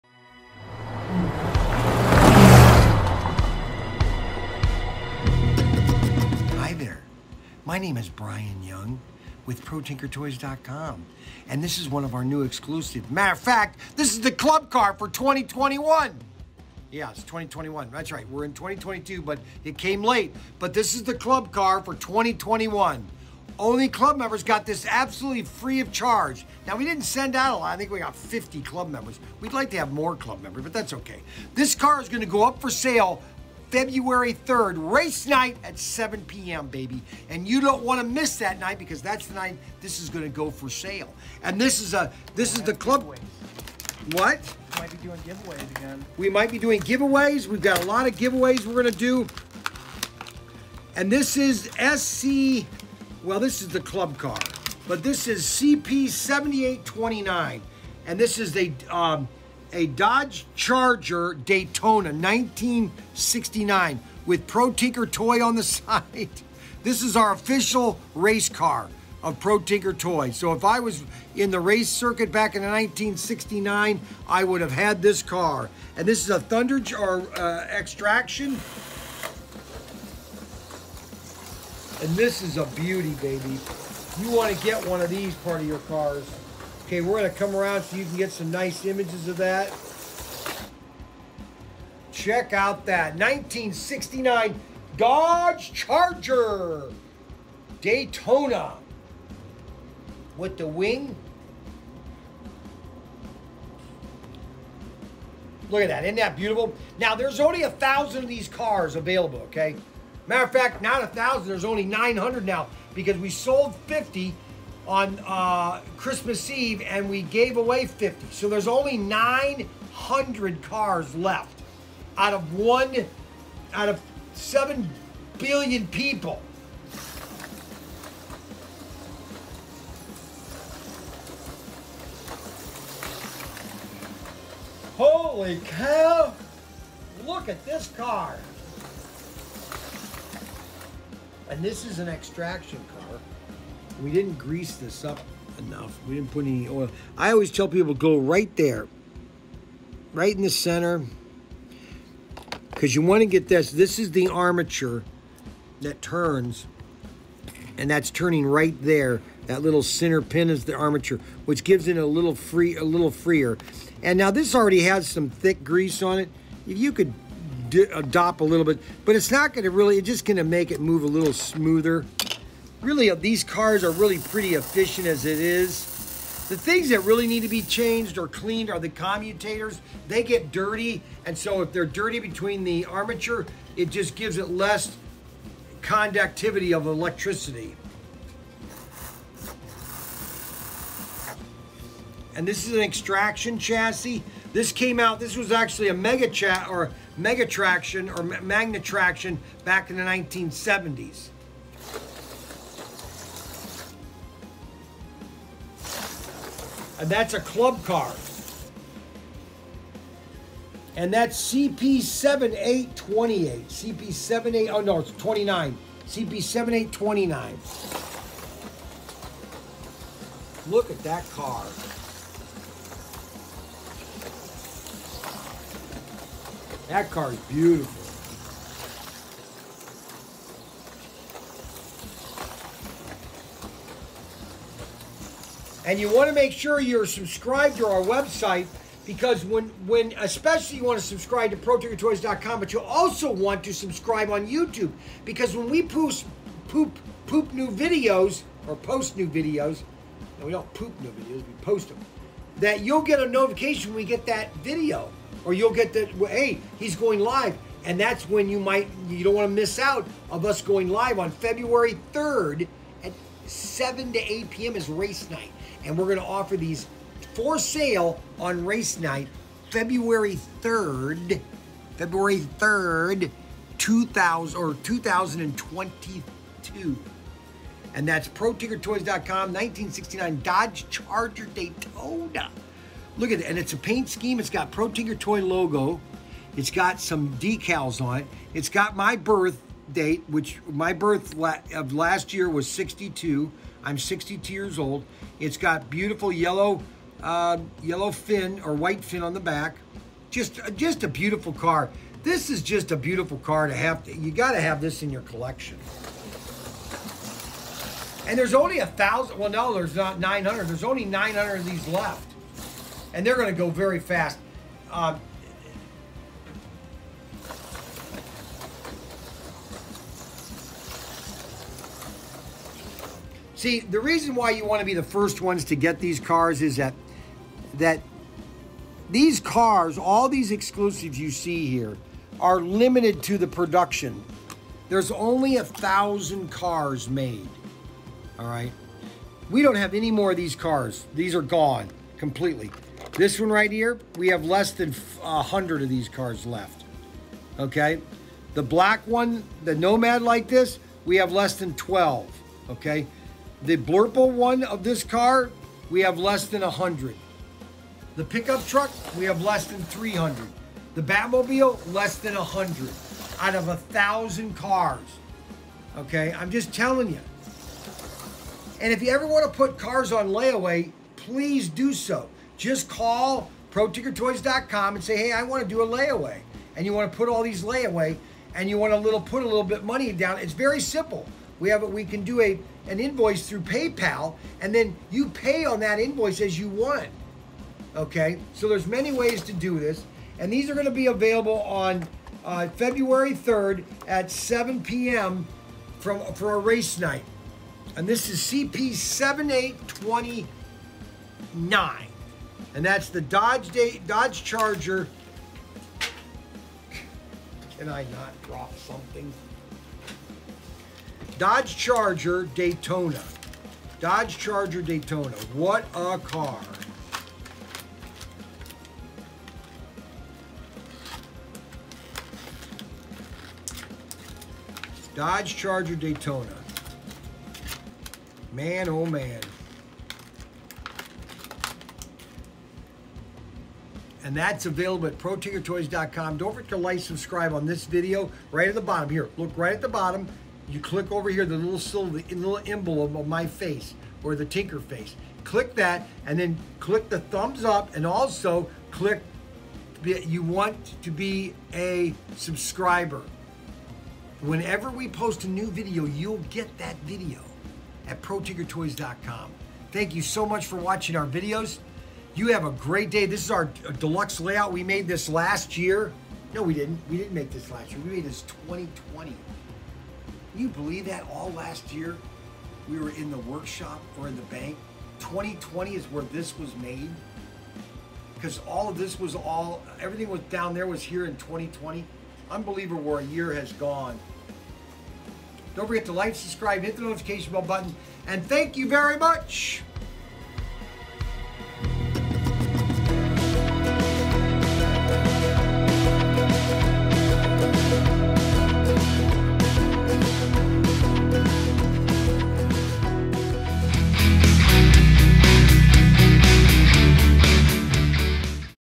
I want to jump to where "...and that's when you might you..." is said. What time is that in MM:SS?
04:17.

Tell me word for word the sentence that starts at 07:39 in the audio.
Thank you so much for watching our videos.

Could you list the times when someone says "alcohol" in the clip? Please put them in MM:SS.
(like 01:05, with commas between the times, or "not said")
not said.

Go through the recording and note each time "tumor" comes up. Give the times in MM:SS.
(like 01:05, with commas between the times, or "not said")
not said.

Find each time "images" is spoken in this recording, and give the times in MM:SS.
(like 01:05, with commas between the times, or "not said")
01:28.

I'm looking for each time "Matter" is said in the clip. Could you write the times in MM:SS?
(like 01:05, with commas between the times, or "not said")
00:13, 01:50.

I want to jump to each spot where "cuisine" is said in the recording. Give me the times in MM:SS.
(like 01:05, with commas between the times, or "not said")
not said.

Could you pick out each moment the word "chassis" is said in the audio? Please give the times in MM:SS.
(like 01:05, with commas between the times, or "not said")
03:13.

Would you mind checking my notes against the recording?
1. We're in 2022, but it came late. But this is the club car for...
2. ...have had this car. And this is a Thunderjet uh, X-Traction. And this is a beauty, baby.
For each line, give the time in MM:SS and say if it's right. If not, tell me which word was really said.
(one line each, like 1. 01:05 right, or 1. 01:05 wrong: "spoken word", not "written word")
1. 00:18 right
2. 01:14 right.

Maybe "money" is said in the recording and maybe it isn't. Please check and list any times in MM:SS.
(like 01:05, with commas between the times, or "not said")
06:19.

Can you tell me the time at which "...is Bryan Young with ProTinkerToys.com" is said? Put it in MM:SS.
00:07.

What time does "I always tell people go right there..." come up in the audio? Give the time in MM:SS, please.
02:27.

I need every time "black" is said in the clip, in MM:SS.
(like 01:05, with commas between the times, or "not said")
05:48.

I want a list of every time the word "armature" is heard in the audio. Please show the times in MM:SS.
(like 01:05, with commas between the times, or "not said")
02:34, 02:40, 03:02.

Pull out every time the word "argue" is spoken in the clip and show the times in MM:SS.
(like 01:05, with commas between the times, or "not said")
not said.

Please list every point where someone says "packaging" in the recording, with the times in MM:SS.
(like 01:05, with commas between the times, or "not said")
not said.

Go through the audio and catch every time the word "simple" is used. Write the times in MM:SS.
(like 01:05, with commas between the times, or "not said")
06:20.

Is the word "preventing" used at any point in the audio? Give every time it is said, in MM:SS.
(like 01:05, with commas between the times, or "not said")
not said.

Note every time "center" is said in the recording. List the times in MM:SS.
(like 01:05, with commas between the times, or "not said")
02:30, 02:39.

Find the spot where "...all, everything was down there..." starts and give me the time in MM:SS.
07:59.